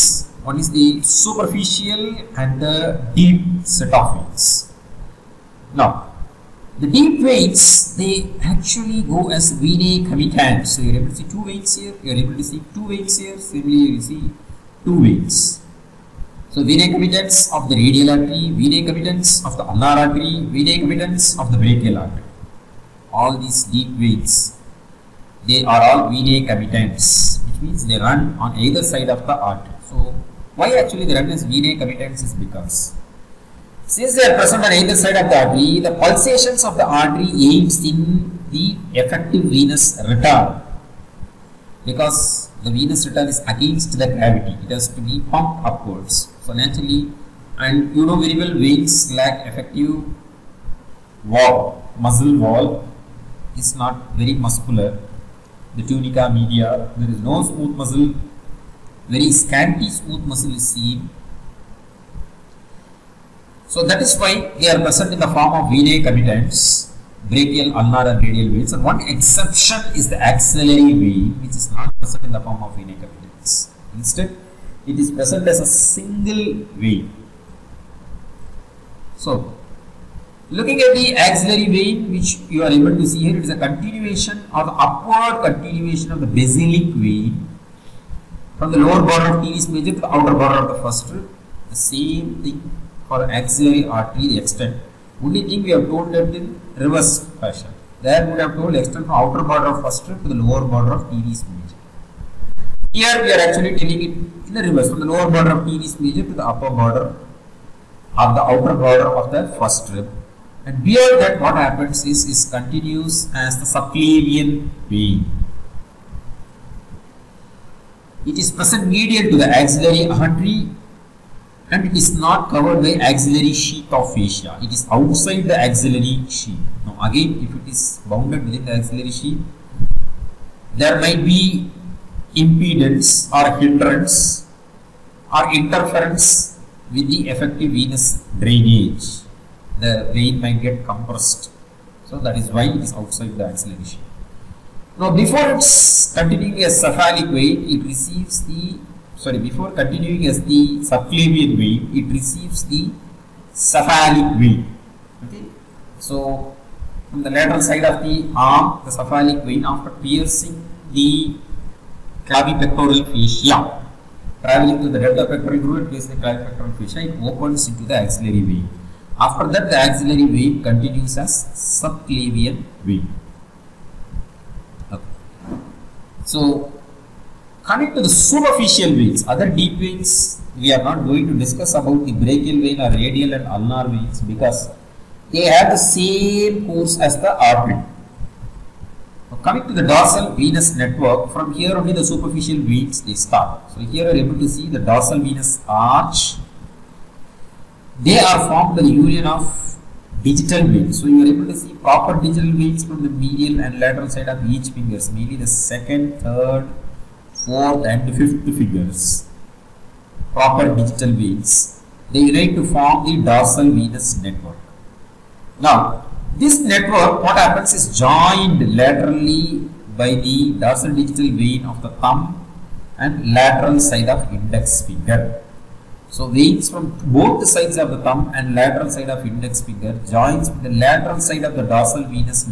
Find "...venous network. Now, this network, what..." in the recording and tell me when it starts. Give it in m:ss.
3:33.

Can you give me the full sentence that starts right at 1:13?
Instead, it is present as a single vein.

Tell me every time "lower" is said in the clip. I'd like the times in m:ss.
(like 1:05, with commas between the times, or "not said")
1:28, 1:40, 1:45.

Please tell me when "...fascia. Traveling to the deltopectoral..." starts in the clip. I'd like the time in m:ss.
2:43.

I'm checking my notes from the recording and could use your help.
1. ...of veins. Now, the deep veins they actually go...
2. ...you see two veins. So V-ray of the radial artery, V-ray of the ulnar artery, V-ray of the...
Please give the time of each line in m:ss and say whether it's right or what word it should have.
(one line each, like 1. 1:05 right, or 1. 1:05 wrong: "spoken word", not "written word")
1. 0:03 right
2. 0:13 right.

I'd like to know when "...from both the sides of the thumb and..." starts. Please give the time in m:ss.
3:46.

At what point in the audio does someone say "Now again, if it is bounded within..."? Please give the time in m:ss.
2:06.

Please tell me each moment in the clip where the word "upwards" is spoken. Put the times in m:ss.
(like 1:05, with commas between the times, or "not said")
0:45, 1:24.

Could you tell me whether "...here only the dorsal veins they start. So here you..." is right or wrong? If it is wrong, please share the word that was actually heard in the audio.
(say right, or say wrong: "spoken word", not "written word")
wrong: "superficial", not "dorsal".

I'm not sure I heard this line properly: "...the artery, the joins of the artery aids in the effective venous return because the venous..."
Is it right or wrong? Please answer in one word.
wrong.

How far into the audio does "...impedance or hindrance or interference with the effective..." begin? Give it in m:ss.
2:12.